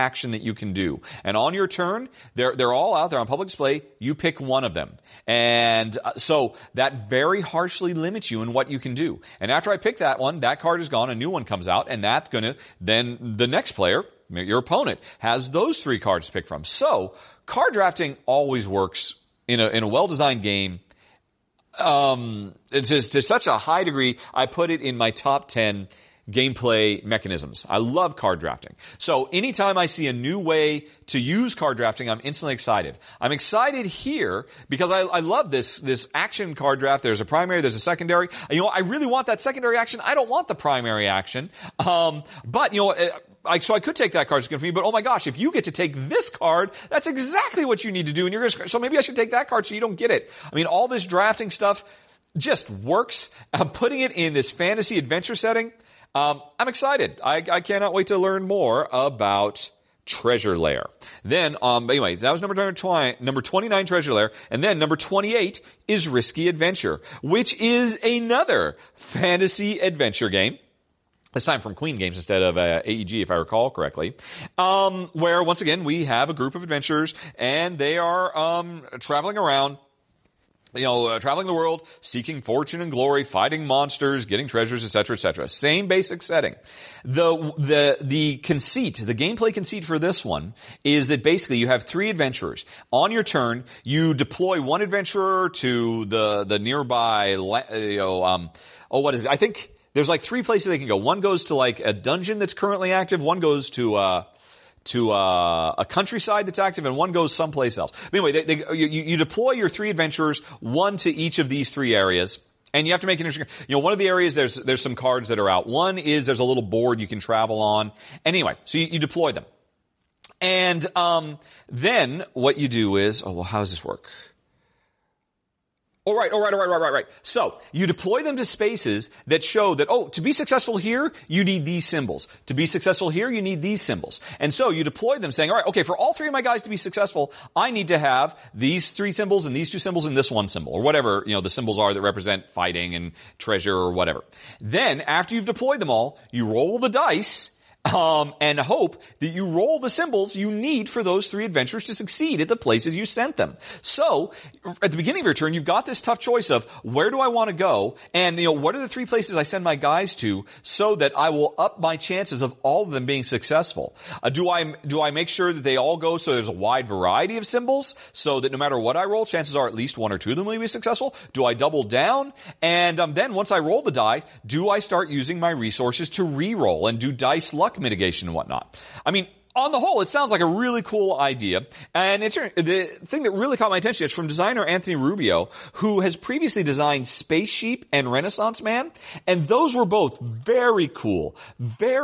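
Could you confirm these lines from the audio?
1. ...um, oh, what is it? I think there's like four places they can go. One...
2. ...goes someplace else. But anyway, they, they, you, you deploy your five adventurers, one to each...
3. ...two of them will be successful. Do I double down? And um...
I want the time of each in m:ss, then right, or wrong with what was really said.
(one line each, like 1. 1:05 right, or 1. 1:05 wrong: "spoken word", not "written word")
1. 1:38 wrong: "three", not "four"
2. 1:47 wrong: "three", not "five"
3. 2:50 right.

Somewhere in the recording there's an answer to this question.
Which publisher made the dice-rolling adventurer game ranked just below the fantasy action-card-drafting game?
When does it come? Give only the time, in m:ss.
1:11.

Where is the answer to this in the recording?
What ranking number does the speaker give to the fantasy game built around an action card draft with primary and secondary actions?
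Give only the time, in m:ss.
1:03.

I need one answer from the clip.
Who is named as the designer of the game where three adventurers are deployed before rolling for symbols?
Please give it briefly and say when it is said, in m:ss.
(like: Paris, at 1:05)
Anthony Rubio, at 3:04.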